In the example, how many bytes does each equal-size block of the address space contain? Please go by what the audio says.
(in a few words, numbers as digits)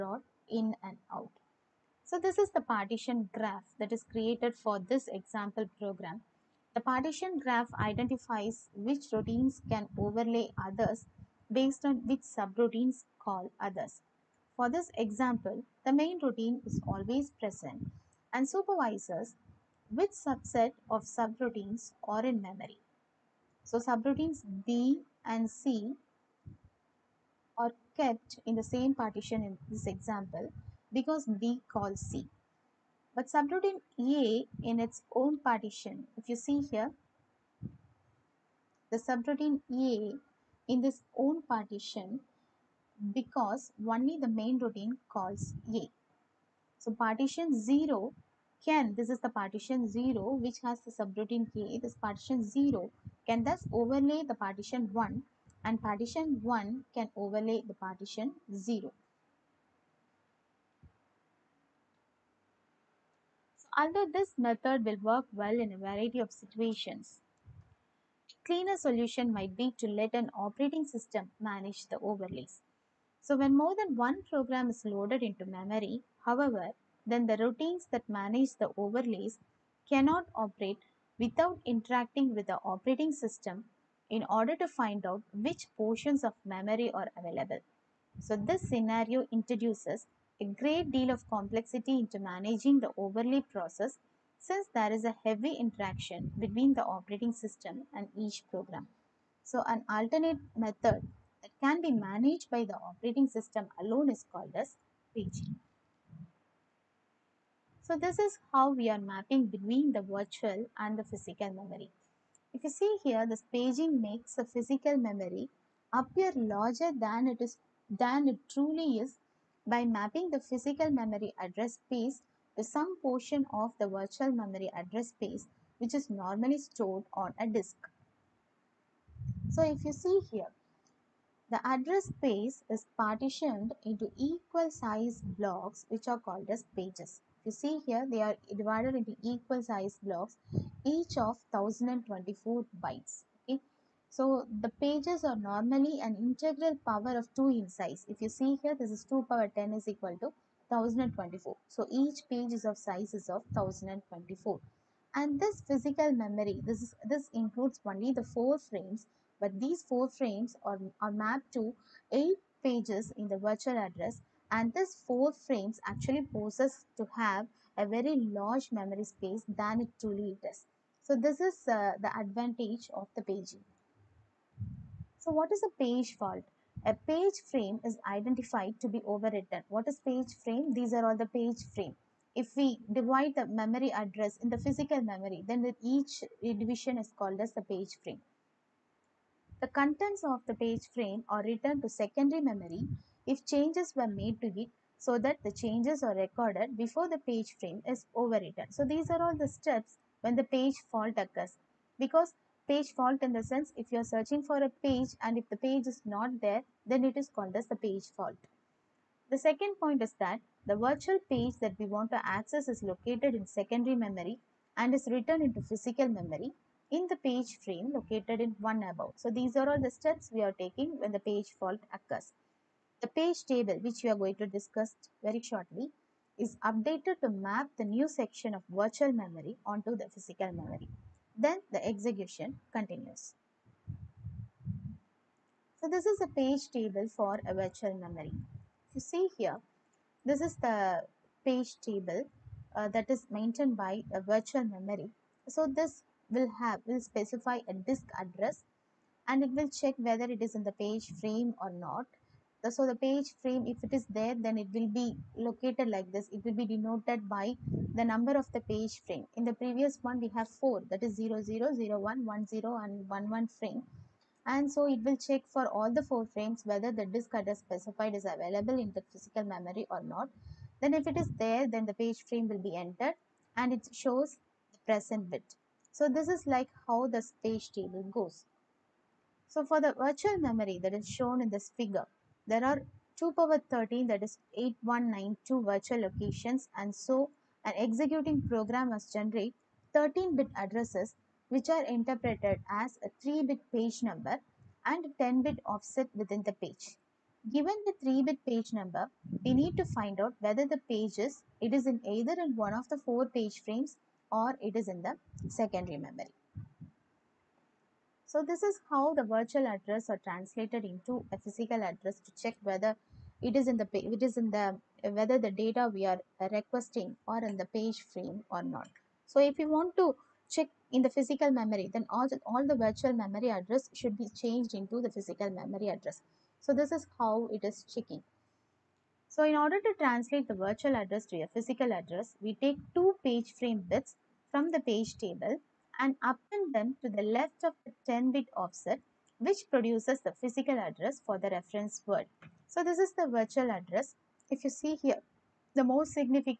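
1024.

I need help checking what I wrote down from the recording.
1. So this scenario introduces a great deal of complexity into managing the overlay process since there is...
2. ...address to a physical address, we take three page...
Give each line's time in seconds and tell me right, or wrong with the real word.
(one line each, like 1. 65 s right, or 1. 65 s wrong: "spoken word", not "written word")
1. 88 s right
2. 330 s wrong: "two", not "three".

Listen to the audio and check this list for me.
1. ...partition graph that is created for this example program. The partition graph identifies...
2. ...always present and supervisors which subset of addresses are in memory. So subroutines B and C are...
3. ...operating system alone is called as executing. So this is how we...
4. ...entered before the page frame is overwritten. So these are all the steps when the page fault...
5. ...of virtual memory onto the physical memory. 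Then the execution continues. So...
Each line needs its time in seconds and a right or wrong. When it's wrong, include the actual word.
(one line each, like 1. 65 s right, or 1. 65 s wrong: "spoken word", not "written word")
1. 2 s right
2. 16 s wrong: "subroutines", not "addresses"
3. 102 s wrong: "paging", not "executing"
4. 196 s wrong: "recorded", not "entered"
5. 228 s right.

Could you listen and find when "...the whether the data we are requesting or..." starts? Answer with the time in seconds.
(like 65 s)
314 s.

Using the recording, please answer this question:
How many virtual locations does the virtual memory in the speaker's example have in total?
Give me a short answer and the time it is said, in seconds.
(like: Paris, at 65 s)
8192, at 284 s.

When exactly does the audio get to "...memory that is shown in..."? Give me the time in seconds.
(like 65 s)
280 s.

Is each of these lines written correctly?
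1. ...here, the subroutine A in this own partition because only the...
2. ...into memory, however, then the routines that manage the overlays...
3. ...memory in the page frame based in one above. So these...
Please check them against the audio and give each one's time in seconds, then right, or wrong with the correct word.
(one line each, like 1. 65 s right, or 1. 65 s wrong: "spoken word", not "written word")
1. 36 s right
2. 75 s right
3. 216 s wrong: "located", not "based".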